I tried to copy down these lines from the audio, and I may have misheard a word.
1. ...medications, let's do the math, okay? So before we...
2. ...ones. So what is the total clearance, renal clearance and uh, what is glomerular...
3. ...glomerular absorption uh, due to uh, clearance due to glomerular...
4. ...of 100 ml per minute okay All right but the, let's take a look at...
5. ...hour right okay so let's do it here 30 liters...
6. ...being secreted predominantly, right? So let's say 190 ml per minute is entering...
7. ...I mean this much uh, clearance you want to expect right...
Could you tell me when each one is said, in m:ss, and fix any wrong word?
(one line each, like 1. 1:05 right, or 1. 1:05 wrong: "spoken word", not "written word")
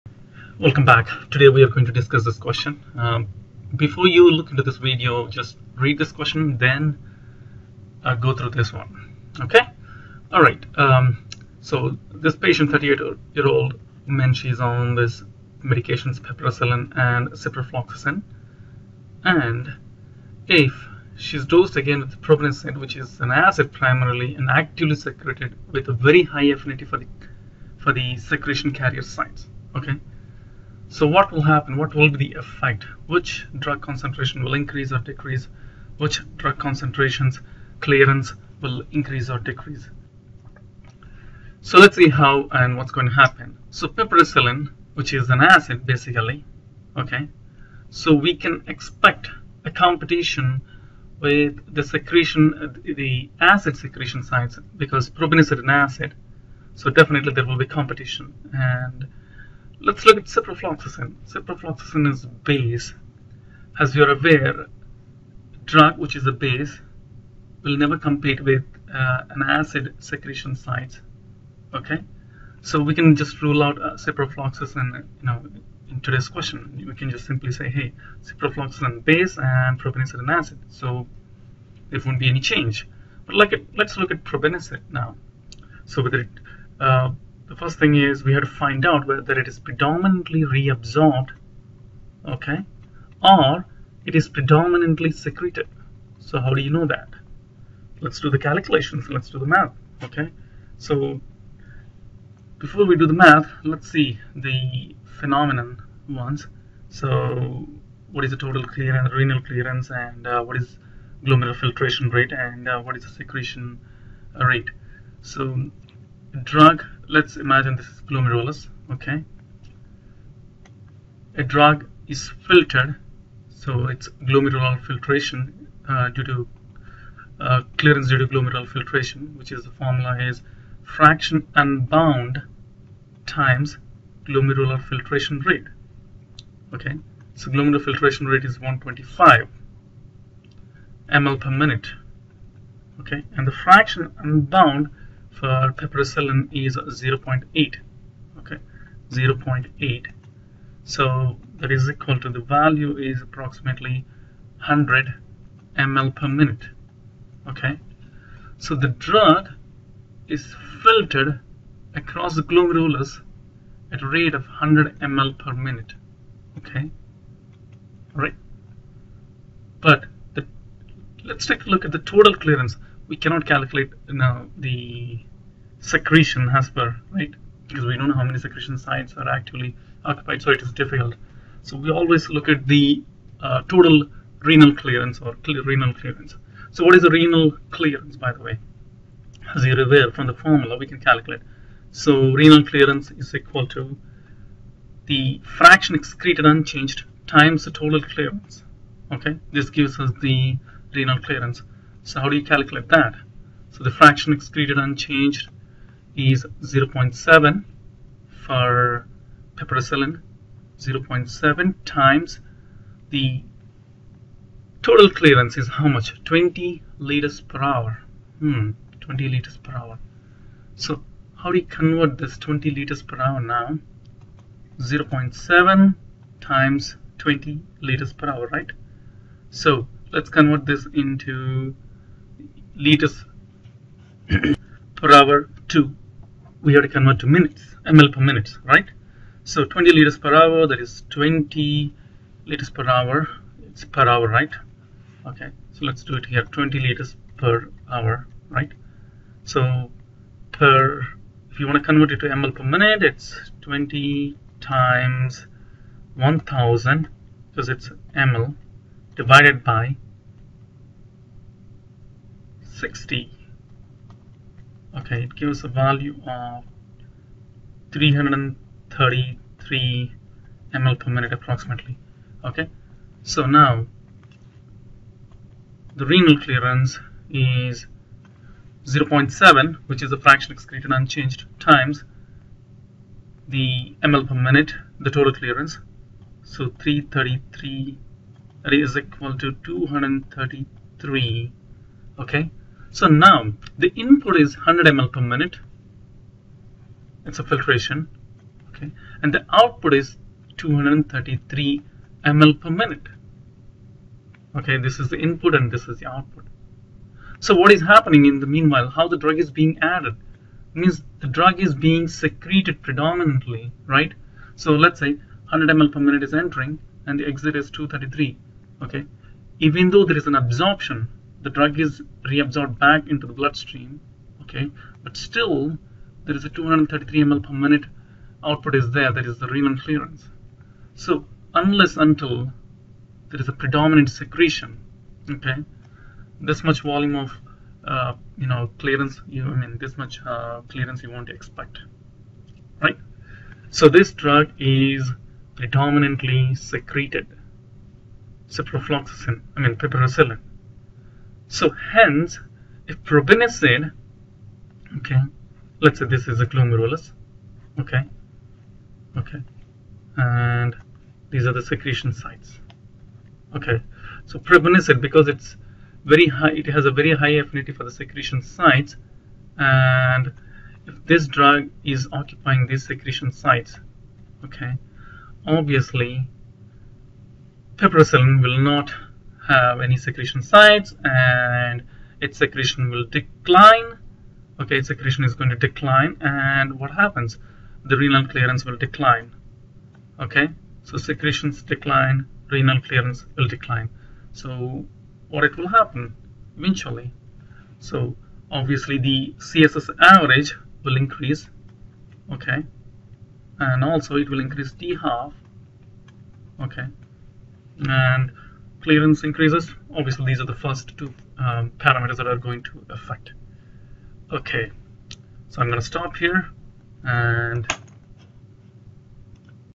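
1. 1:38 wrong: "calculations", not "medications"
2. 1:46 right
3. 2:04 wrong: "filtration", not "absorption"
4. 2:44 right
5. 4:04 wrong: "20", not "30"
6. 5:11 wrong: "100", not "190"
7. 5:39 right.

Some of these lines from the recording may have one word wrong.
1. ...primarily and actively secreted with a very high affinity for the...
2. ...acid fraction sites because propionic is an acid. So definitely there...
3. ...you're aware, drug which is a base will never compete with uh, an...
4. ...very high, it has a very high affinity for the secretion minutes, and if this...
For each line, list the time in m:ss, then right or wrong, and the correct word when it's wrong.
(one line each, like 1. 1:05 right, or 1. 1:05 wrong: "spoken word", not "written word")
1. 0:23 right
2. 0:53 wrong: "secretion", not "fraction"
3. 1:03 right
4. 6:06 wrong: "sites", not "minutes".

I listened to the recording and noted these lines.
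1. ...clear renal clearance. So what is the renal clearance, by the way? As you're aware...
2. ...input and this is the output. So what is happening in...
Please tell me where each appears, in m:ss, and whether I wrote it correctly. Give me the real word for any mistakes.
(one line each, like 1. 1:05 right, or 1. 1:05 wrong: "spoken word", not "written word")
1. 3:05 right
2. 5:05 right.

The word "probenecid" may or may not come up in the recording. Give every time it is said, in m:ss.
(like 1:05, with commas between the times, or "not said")
0:22, 1:19, 1:24, 5:53, 6:04.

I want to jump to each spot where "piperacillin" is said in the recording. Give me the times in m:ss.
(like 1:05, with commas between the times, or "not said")
0:16, 0:43, 2:25, 3:29, 5:49, 6:17.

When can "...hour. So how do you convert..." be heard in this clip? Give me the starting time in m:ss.
3:39.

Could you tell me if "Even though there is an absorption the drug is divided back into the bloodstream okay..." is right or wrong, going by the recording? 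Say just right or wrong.
wrong.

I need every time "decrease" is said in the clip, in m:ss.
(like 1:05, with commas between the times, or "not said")
0:34, 0:39.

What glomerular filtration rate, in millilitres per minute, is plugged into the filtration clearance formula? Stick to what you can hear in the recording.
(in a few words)
125 ml per minute.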